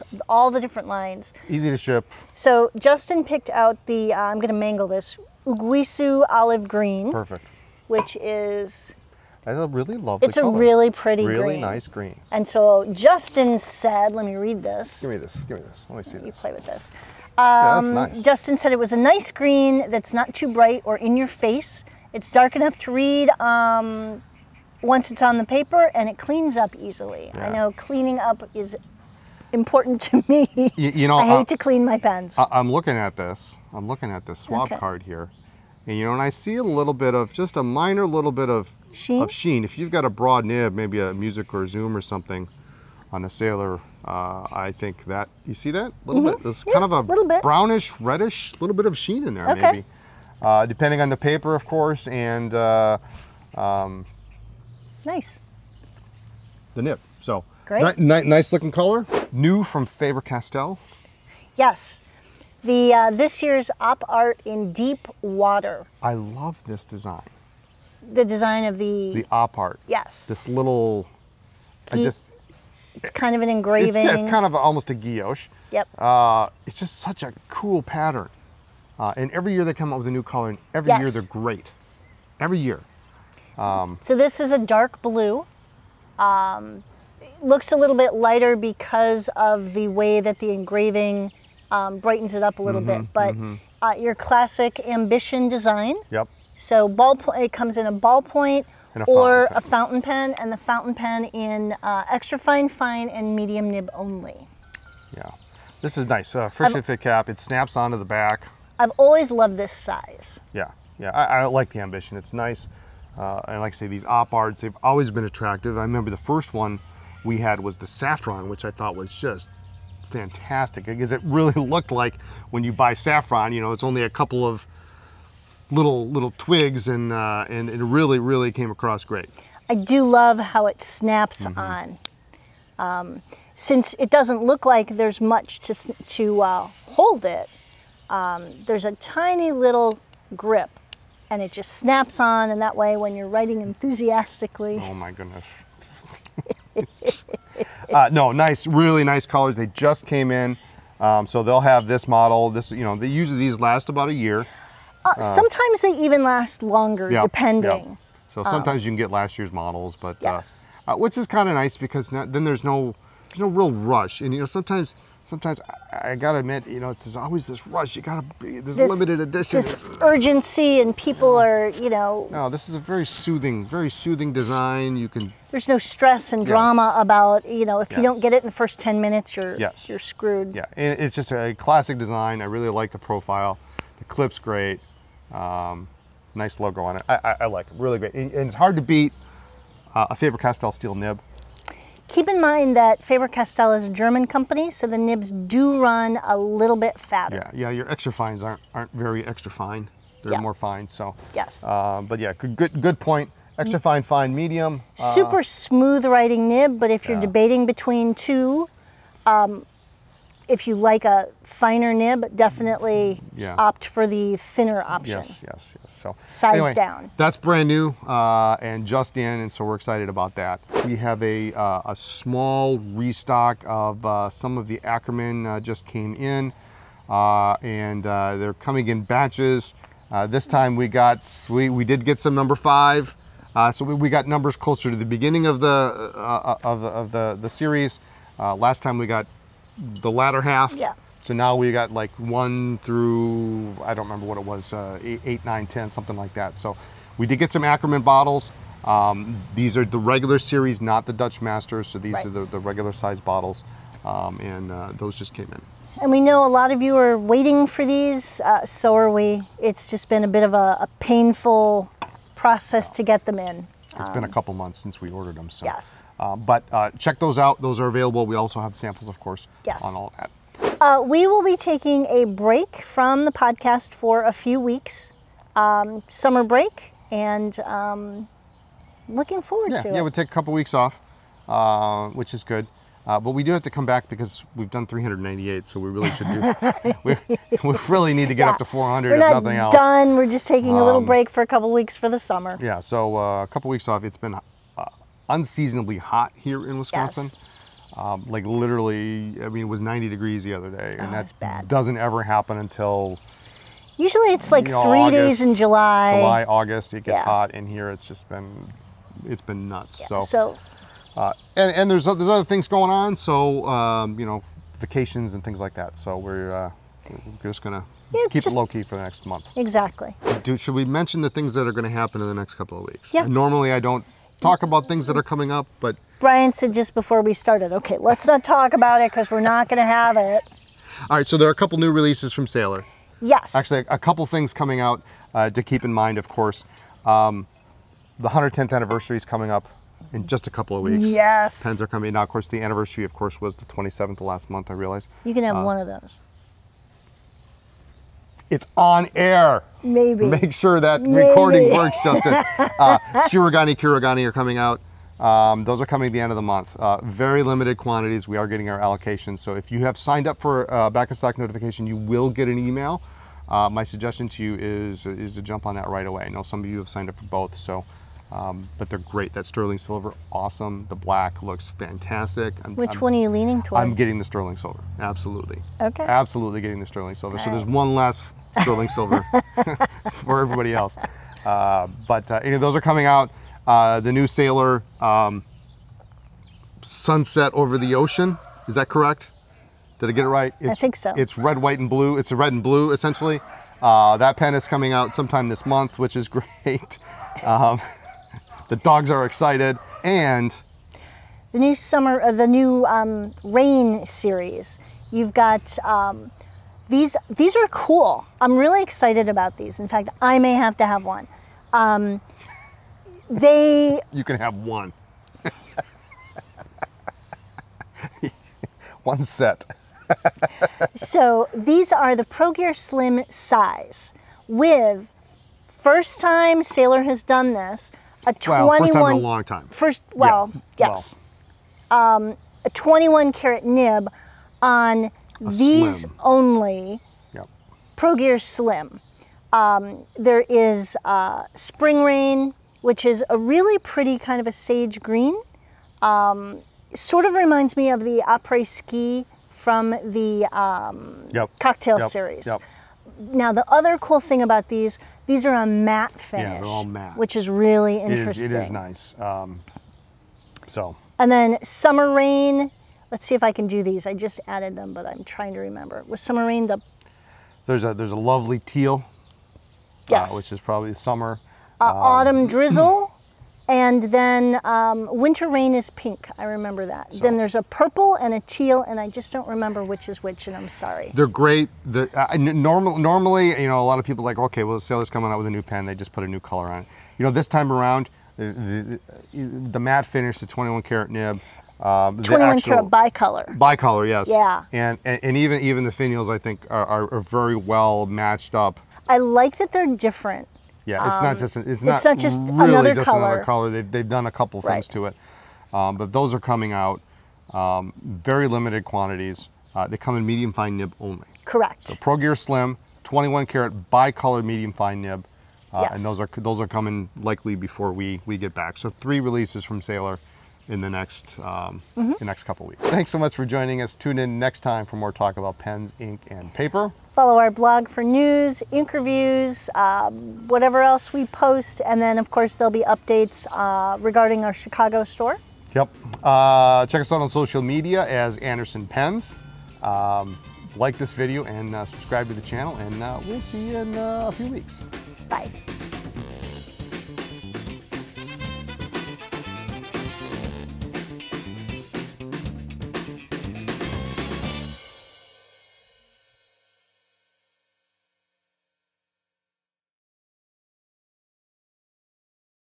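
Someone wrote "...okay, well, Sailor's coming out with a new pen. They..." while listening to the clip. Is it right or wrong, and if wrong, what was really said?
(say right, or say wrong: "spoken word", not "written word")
right.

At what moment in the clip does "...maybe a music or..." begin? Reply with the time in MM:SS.
00:40.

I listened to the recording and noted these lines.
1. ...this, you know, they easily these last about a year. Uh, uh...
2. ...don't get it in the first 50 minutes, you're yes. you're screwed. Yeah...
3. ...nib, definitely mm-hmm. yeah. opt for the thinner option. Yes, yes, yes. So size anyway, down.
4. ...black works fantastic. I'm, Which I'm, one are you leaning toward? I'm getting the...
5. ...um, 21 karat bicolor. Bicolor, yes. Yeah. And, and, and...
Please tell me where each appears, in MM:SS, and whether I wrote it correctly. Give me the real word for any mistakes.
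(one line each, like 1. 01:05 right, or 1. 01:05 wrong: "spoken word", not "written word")
1. 02:32 wrong: "usually", not "easily"
2. 02:58 wrong: "10", not "50"
3. 03:31 right
4. 06:10 wrong: "looks", not "works"
5. 08:11 right.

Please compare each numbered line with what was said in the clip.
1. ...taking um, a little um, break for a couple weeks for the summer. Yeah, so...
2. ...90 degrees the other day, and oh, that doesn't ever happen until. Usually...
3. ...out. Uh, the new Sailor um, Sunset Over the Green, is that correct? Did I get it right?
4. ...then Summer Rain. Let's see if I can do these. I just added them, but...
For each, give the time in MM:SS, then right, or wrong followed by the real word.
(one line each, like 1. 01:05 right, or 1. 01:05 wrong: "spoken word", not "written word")
1. 04:50 right
2. 04:59 right
3. 06:23 wrong: "Ocean", not "Green"
4. 07:41 right.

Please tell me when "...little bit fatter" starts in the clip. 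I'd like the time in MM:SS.
03:16.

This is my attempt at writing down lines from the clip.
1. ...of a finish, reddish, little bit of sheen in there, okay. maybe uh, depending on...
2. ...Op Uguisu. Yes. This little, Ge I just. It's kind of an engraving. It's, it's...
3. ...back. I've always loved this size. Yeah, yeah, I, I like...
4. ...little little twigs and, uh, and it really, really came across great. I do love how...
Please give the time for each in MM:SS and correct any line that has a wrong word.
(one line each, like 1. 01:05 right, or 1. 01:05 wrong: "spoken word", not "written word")
1. 00:46 wrong: "brownish", not "finish"
2. 01:09 wrong: "Art", not "Uguisu"
3. 01:48 right
4. 02:05 right.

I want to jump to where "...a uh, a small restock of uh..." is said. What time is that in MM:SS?
03:41.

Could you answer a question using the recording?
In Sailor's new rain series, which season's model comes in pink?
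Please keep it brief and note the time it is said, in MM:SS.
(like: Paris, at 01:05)
Winter Rain, at 07:55.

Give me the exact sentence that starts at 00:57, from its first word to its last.
So great, ni ni nice looking color, new from Faber Castell.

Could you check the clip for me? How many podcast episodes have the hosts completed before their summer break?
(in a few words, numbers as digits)
398.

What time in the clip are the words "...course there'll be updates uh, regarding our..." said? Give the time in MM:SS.
08:52.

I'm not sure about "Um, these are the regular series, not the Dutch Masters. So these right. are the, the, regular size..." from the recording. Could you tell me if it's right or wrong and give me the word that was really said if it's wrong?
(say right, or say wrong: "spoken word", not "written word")
right.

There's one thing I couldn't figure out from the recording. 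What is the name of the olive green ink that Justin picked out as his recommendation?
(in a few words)
Uguisu Olive Green.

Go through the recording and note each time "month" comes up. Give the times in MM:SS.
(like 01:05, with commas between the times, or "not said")
04:24, 05:19, 05:44, 05:56, 06:35.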